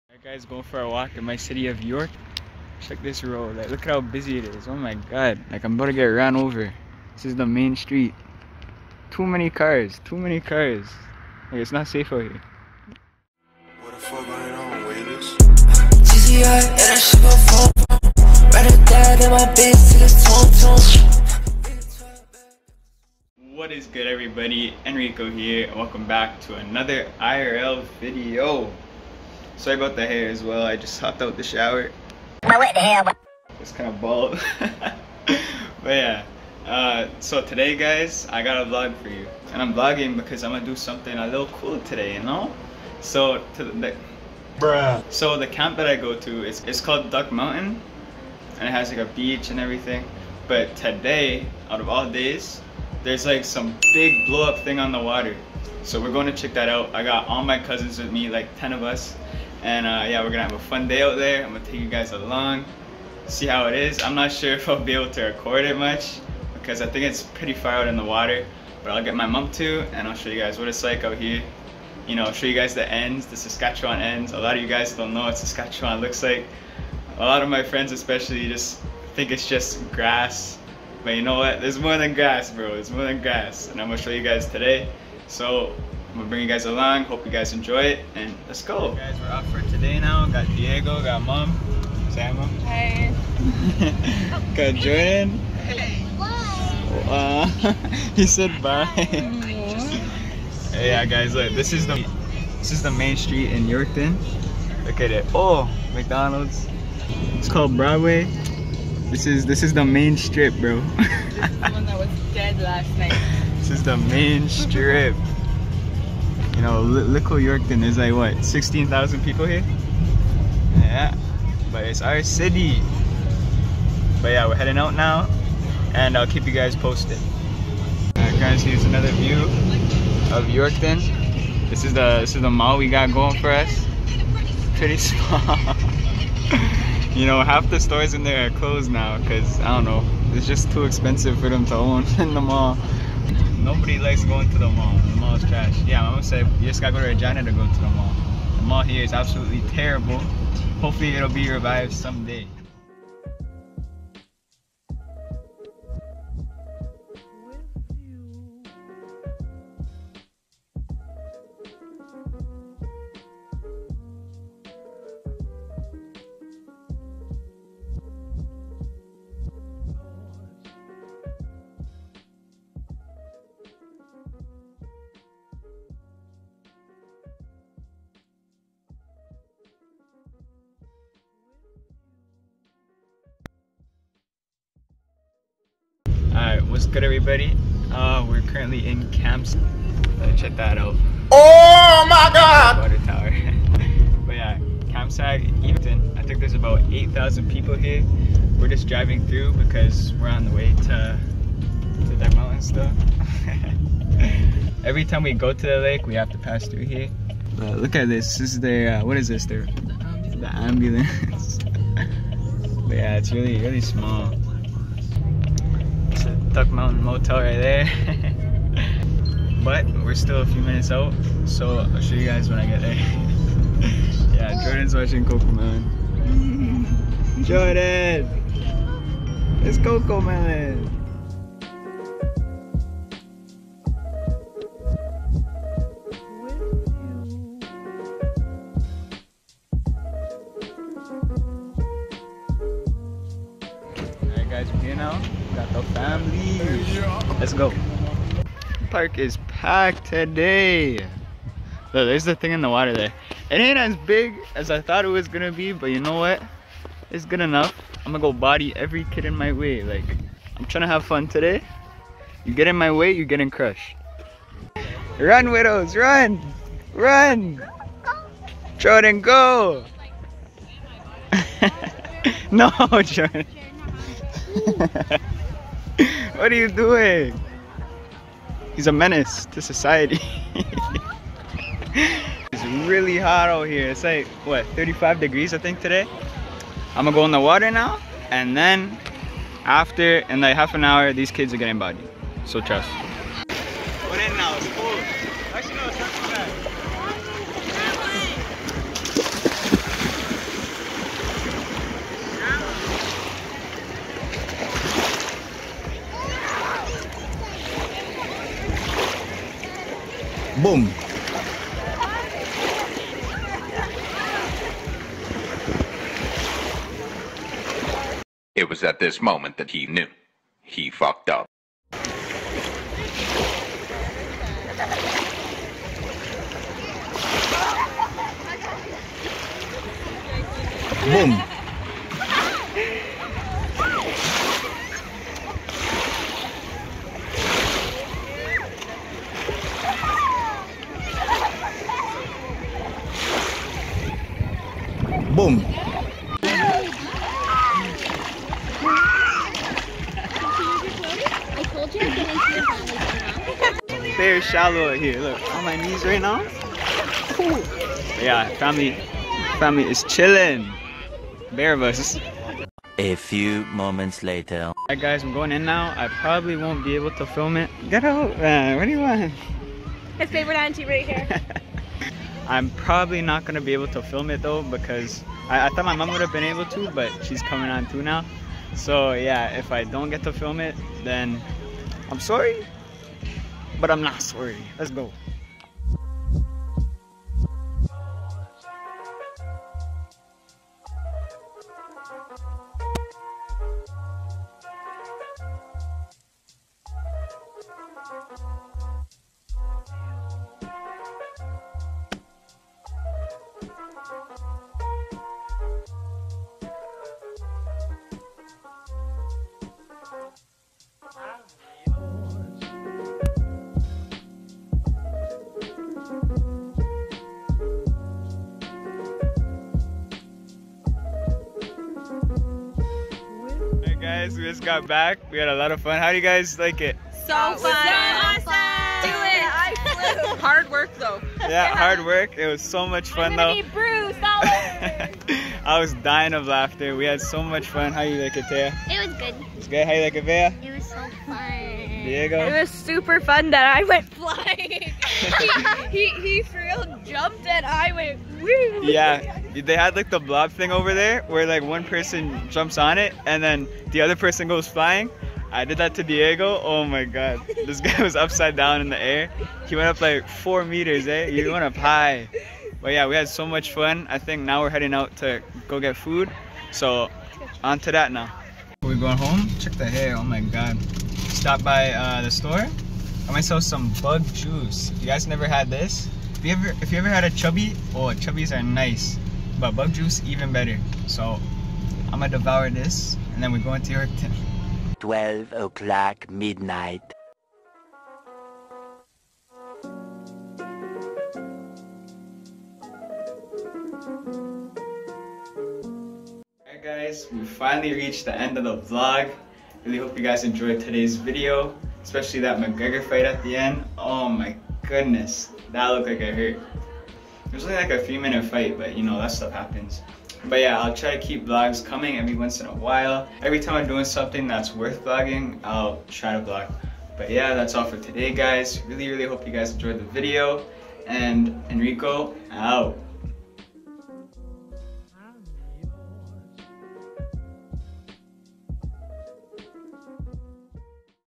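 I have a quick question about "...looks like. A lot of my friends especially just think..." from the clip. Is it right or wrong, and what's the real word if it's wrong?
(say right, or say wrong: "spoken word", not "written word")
right.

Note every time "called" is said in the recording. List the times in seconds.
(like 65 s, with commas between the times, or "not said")
46 s, 107 s.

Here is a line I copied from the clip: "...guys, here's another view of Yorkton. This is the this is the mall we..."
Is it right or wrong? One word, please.
right.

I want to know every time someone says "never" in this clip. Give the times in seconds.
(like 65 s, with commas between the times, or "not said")
475 s.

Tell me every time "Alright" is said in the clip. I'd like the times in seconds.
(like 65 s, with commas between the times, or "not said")
128 s, 364 s, 496 s.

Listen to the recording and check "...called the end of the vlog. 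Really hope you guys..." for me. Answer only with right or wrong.
wrong.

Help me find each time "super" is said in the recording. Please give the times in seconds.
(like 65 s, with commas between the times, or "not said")
442 s.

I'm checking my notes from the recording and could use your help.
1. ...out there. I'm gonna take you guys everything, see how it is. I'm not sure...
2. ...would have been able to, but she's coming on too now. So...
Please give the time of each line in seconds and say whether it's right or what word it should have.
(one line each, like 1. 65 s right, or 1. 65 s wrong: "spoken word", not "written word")
1. 61 s wrong: "along", not "everything"
2. 376 s right.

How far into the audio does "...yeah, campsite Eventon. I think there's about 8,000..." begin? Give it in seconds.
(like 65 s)
194 s.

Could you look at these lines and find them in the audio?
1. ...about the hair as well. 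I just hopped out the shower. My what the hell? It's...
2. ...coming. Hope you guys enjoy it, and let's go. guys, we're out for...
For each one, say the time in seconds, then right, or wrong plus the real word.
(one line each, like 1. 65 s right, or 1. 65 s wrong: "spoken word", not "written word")
1. 29 s right
2. 86 s wrong: "along", not "coming".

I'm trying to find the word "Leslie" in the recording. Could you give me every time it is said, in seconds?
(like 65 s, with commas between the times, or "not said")
not said.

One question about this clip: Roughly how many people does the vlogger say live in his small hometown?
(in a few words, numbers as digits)
16,000.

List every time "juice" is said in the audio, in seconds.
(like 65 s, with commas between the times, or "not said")
474 s, 479 s.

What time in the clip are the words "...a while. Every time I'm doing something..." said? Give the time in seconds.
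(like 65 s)
512 s.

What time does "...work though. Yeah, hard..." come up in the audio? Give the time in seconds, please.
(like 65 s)
430 s.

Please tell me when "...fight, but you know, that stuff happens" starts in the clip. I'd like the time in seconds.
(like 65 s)
508 s.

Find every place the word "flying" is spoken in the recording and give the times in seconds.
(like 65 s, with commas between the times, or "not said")
444 s, 454 s.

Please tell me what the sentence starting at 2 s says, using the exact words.
Check this road, like look at how busy it is.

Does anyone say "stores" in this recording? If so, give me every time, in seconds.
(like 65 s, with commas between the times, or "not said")
137 s, 472 s.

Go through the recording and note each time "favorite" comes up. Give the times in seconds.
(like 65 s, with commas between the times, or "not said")
370 s.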